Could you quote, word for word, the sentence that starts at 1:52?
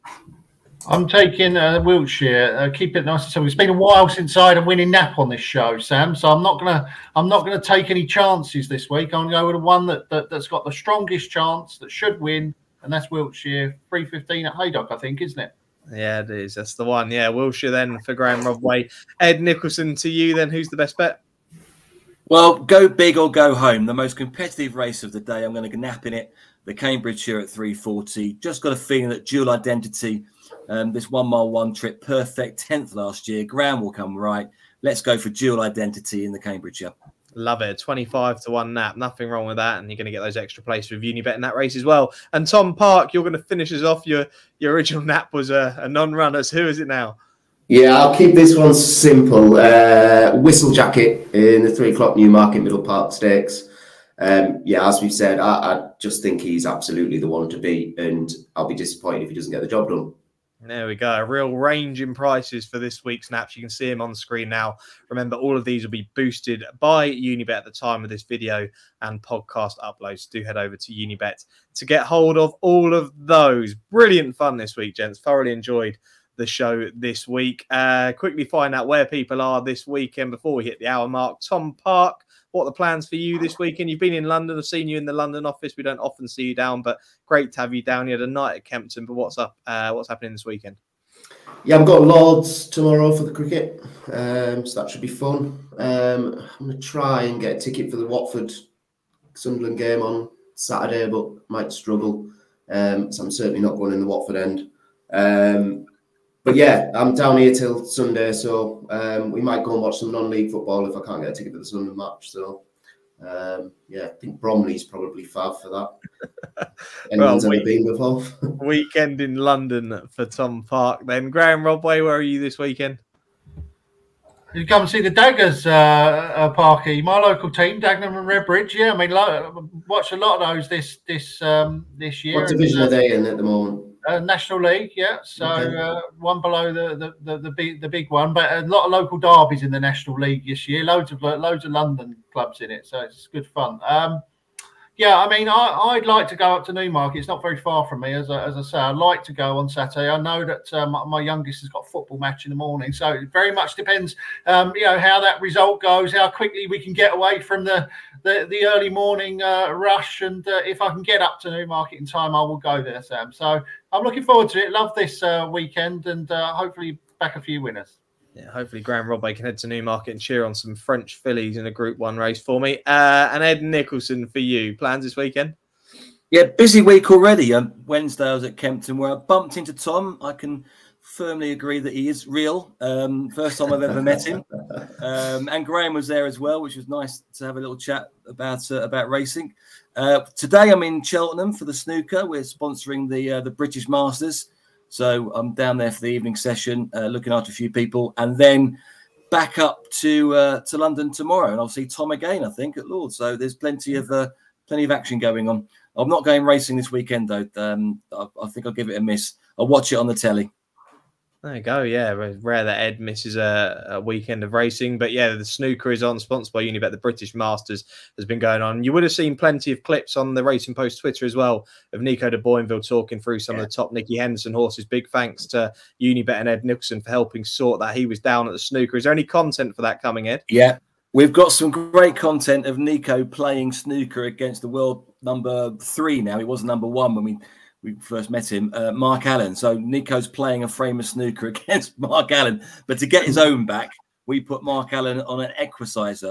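So um, yeah, I think Bromley's probably far for that.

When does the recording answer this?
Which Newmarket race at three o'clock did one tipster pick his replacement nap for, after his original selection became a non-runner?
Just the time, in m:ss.
0:52.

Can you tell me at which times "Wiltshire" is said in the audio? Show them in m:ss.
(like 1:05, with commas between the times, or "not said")
0:01, 0:13, 0:17.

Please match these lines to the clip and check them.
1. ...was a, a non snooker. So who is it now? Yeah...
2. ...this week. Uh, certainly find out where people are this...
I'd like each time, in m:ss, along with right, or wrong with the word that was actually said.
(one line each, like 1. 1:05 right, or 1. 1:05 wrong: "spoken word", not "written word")
1. 0:45 wrong: "runner", not "snooker"
2. 1:16 wrong: "quickly", not "certainly".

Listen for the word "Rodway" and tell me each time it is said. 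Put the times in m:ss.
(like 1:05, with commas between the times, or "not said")
0:18, 2:01, 2:49.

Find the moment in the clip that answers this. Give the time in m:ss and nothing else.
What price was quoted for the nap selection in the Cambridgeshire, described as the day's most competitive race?
0:37.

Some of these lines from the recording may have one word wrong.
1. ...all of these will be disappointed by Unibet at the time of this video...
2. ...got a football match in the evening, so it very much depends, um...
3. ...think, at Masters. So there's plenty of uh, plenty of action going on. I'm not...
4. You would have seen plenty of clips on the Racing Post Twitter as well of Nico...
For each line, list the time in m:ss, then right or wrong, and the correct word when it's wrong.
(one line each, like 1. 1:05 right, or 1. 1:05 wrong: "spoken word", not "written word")
1. 1:05 wrong: "boosted", not "disappointed"
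2. 2:31 wrong: "morning", not "evening"
3. 3:22 wrong: "Lord", not "Masters"
4. 3:38 right.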